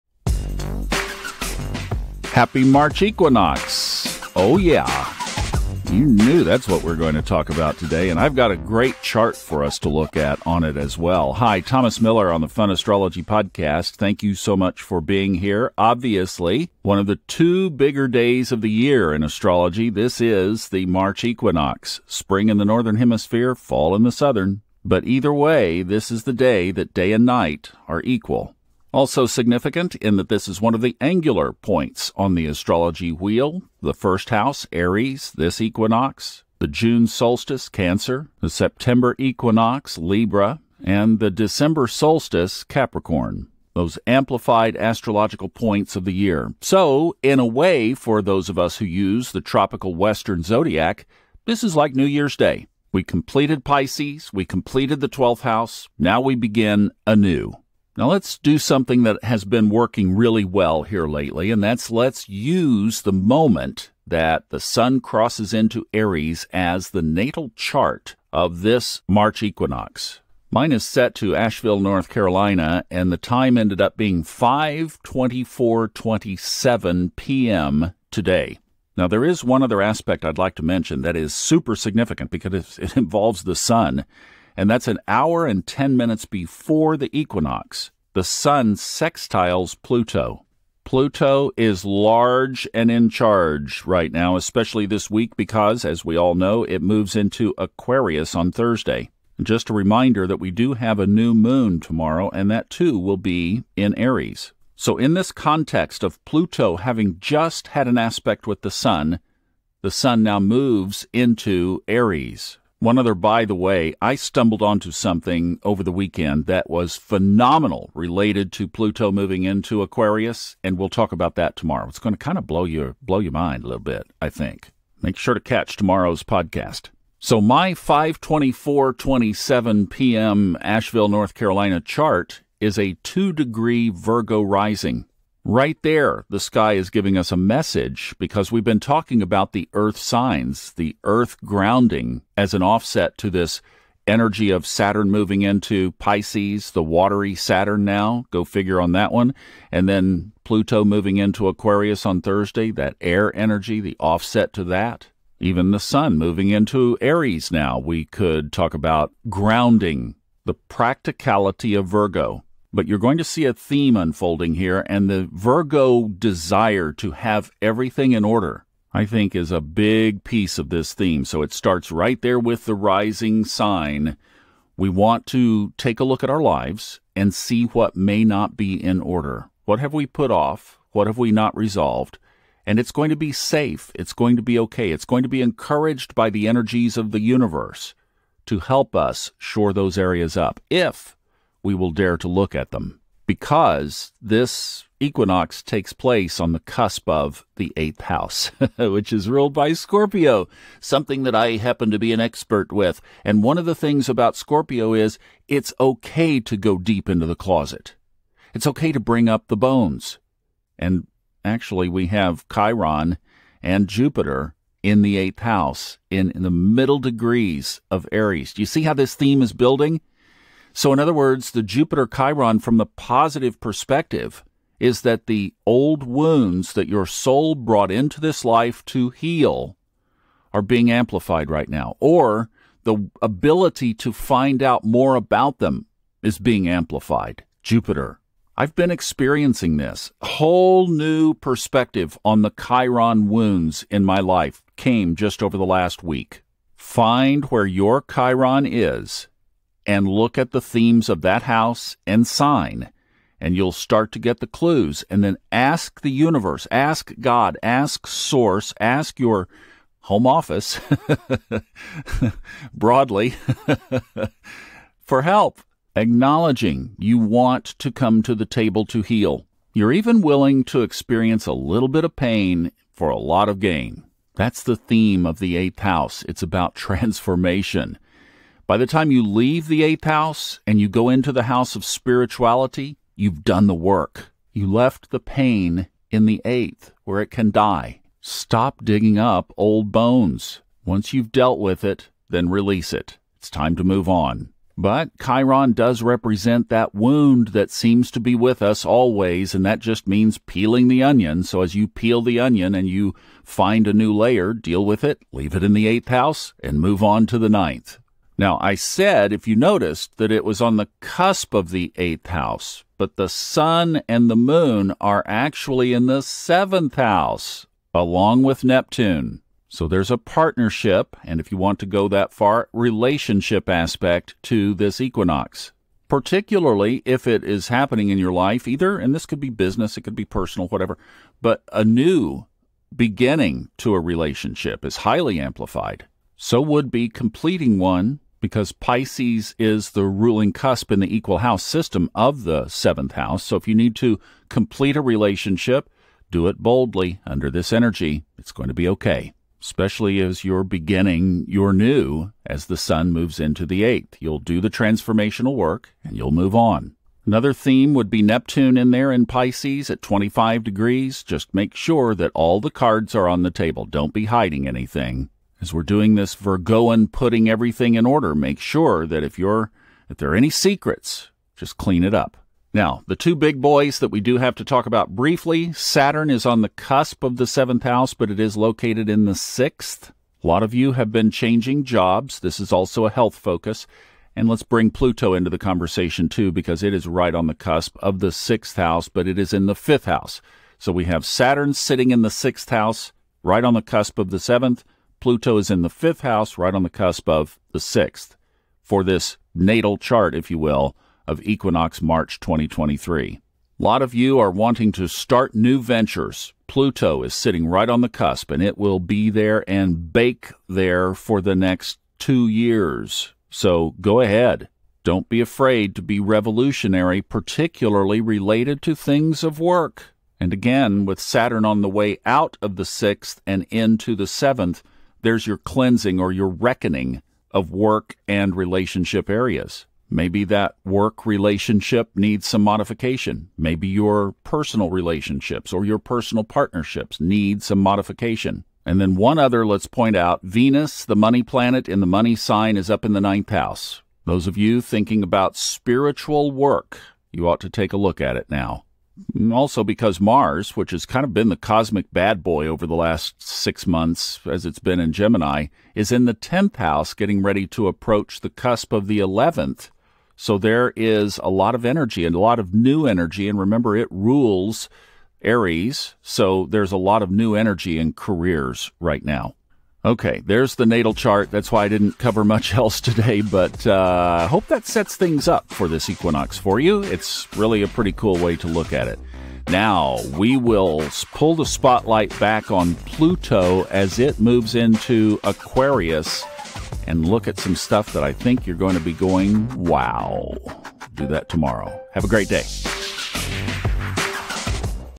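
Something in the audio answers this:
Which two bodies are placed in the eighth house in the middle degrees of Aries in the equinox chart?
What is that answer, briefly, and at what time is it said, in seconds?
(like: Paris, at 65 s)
Chiron and Jupiter, at 212 s.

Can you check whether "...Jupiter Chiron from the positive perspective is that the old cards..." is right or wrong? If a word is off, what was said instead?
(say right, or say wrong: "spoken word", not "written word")
wrong: "wounds", not "cards".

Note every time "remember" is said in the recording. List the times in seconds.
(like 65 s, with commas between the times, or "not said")
463 s.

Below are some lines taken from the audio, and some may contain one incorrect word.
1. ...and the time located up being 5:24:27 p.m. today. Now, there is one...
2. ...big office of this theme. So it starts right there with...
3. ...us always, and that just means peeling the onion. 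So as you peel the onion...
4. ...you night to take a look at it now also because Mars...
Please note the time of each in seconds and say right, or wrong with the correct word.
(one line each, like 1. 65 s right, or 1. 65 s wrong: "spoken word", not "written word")
1. 72 s wrong: "ended", not "located"
2. 169 s wrong: "piece", not "office"
3. 298 s right
4. 447 s wrong: "ought", not "night".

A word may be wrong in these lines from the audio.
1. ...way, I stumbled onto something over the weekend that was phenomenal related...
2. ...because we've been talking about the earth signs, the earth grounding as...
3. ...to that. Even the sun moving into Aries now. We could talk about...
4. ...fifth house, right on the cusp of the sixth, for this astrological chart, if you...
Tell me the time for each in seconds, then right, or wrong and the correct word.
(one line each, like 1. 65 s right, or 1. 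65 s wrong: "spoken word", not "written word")
1. 113 s right
2. 138 s right
3. 154 s right
4. 395 s wrong: "natal", not "astrological".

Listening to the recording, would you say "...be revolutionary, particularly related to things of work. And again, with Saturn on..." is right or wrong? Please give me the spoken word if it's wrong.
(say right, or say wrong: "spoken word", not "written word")
right.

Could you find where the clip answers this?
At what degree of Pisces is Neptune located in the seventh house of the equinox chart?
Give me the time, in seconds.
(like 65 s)
360 s.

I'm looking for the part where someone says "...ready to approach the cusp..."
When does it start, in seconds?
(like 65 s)
457 s.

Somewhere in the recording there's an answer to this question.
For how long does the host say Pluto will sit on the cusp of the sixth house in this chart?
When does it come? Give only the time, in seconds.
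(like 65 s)
412 s.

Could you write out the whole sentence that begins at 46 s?
So, in a way, for those of us who use the tropical Western zodiac, this is like New Year's Day.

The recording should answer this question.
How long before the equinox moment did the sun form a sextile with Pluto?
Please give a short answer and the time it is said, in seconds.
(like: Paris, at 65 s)
1 hour and 10 minutes, at 84 s.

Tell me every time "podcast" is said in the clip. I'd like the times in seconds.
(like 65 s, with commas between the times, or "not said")
13 s, 126 s.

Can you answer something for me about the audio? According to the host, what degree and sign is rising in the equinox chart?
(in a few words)
2 degree Virgo.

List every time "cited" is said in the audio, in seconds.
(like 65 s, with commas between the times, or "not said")
not said.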